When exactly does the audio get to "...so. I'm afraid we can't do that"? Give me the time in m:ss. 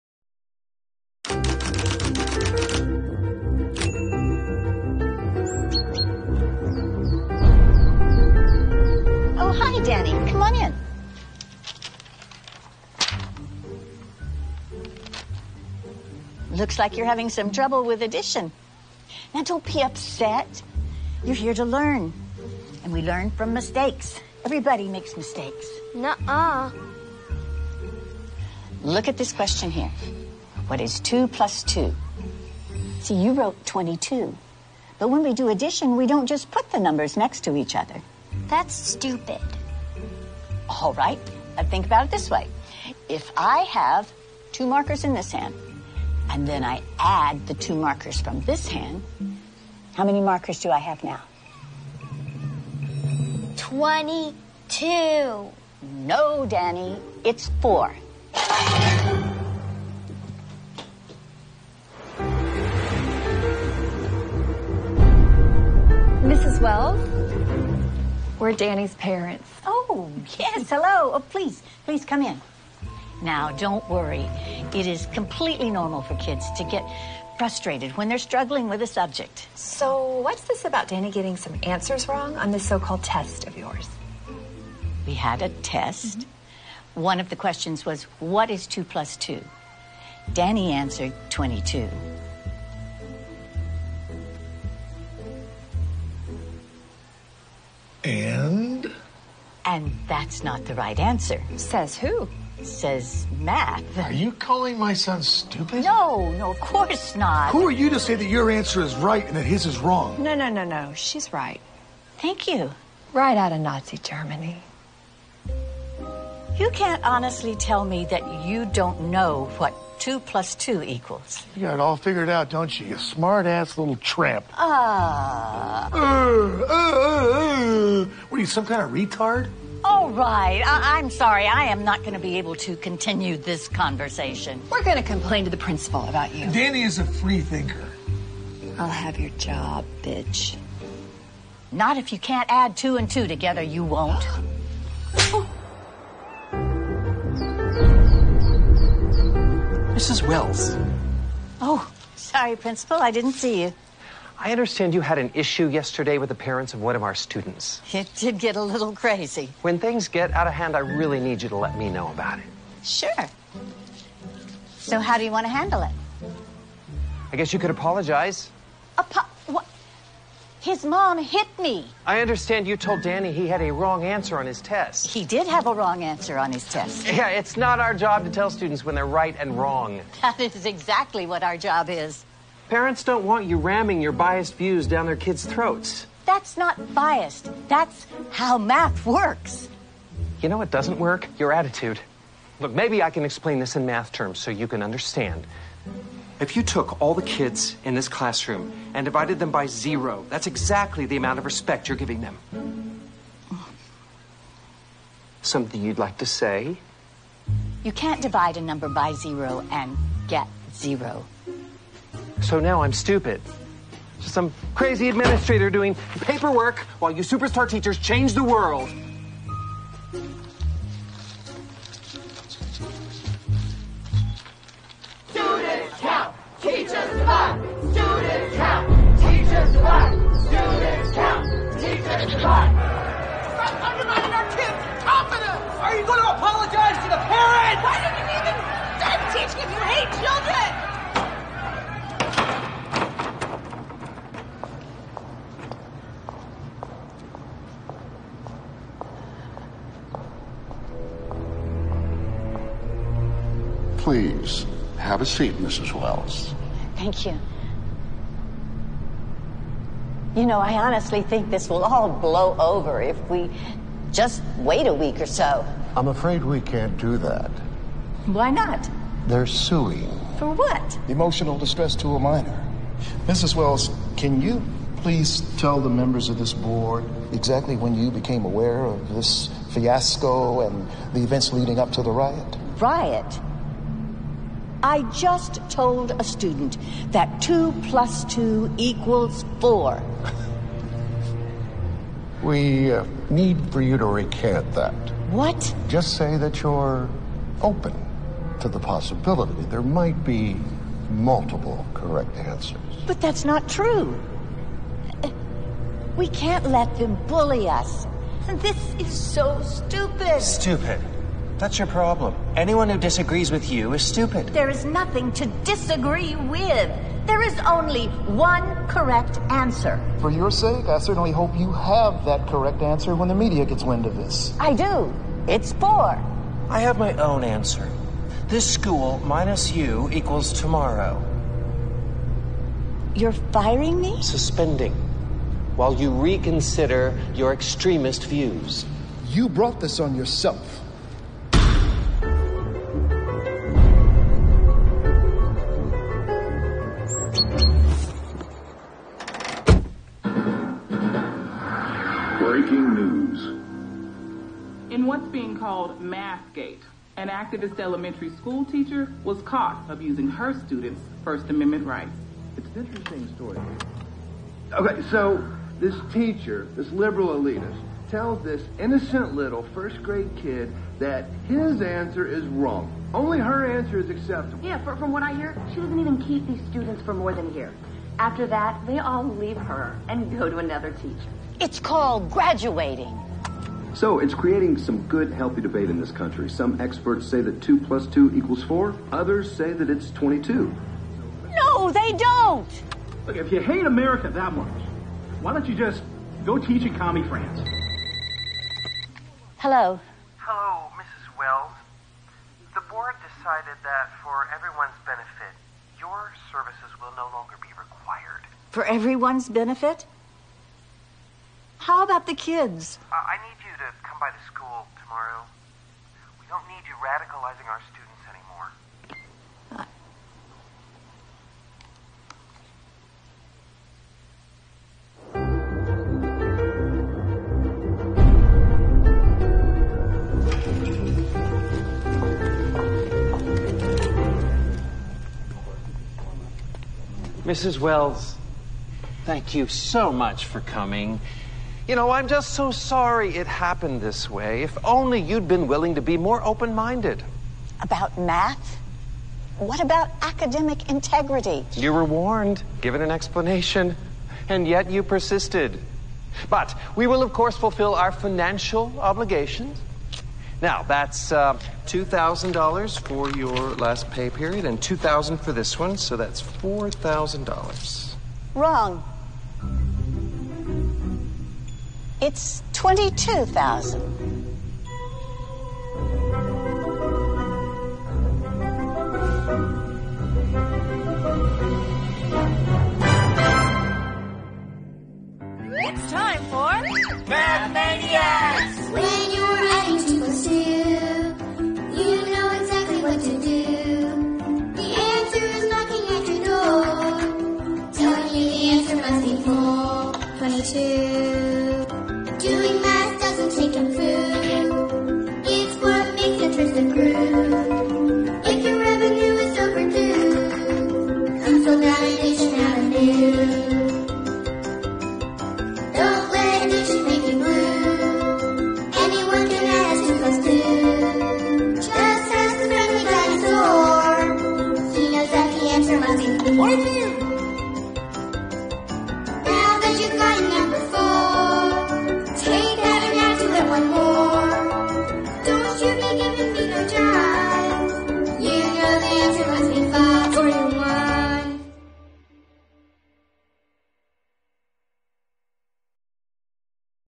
4:25.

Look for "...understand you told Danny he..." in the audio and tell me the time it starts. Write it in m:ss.
2:52.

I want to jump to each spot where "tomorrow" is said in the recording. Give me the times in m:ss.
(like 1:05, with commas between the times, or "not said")
5:30, 6:55.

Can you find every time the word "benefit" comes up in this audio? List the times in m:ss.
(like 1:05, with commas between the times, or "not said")
6:45, 6:49.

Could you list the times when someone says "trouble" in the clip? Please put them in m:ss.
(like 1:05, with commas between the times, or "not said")
0:17.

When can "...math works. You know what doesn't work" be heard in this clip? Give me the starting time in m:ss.
3:08.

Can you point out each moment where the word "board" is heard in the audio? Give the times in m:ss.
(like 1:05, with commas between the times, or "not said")
4:36, 6:42.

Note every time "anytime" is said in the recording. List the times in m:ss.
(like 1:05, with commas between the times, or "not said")
not said.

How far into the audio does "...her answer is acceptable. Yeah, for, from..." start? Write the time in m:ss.
6:13.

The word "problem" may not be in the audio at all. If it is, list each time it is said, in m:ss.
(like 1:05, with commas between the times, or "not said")
5:11.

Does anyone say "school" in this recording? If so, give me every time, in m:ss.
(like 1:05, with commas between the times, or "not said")
5:28, 5:58, 6:54.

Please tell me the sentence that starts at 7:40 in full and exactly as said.
Now, that's uh, $2,000 for your last pay period and 2000 for this one, so that's $4,000.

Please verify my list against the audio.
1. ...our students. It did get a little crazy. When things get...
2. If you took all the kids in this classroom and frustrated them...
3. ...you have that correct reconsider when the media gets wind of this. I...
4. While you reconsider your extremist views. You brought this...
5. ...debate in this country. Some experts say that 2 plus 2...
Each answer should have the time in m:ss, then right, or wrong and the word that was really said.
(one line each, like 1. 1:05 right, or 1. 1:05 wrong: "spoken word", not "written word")
1. 2:37 right
2. 3:16 wrong: "divided", not "frustrated"
3. 5:21 wrong: "answer", not "reconsider"
4. 5:35 right
5. 6:25 right.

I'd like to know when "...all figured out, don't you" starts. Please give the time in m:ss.
2:01.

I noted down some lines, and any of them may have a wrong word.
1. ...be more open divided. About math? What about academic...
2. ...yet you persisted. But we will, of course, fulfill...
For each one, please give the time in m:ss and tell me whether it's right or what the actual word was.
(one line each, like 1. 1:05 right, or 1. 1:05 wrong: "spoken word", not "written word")
1. 7:26 wrong: "minded", not "divided"
2. 7:34 right.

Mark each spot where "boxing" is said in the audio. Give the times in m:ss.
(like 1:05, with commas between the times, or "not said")
not said.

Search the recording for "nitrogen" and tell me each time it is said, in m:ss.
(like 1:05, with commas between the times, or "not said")
not said.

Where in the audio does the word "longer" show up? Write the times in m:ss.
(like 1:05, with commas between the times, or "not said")
6:47.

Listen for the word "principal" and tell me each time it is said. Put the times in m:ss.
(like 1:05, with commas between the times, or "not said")
2:15, 2:32.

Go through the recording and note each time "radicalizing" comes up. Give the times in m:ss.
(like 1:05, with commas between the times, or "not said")
6:57.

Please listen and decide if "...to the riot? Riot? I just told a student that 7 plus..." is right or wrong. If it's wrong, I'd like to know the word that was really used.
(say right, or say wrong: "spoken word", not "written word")
wrong: "2", not "7".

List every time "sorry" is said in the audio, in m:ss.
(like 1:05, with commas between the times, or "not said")
2:11, 2:32, 7:22.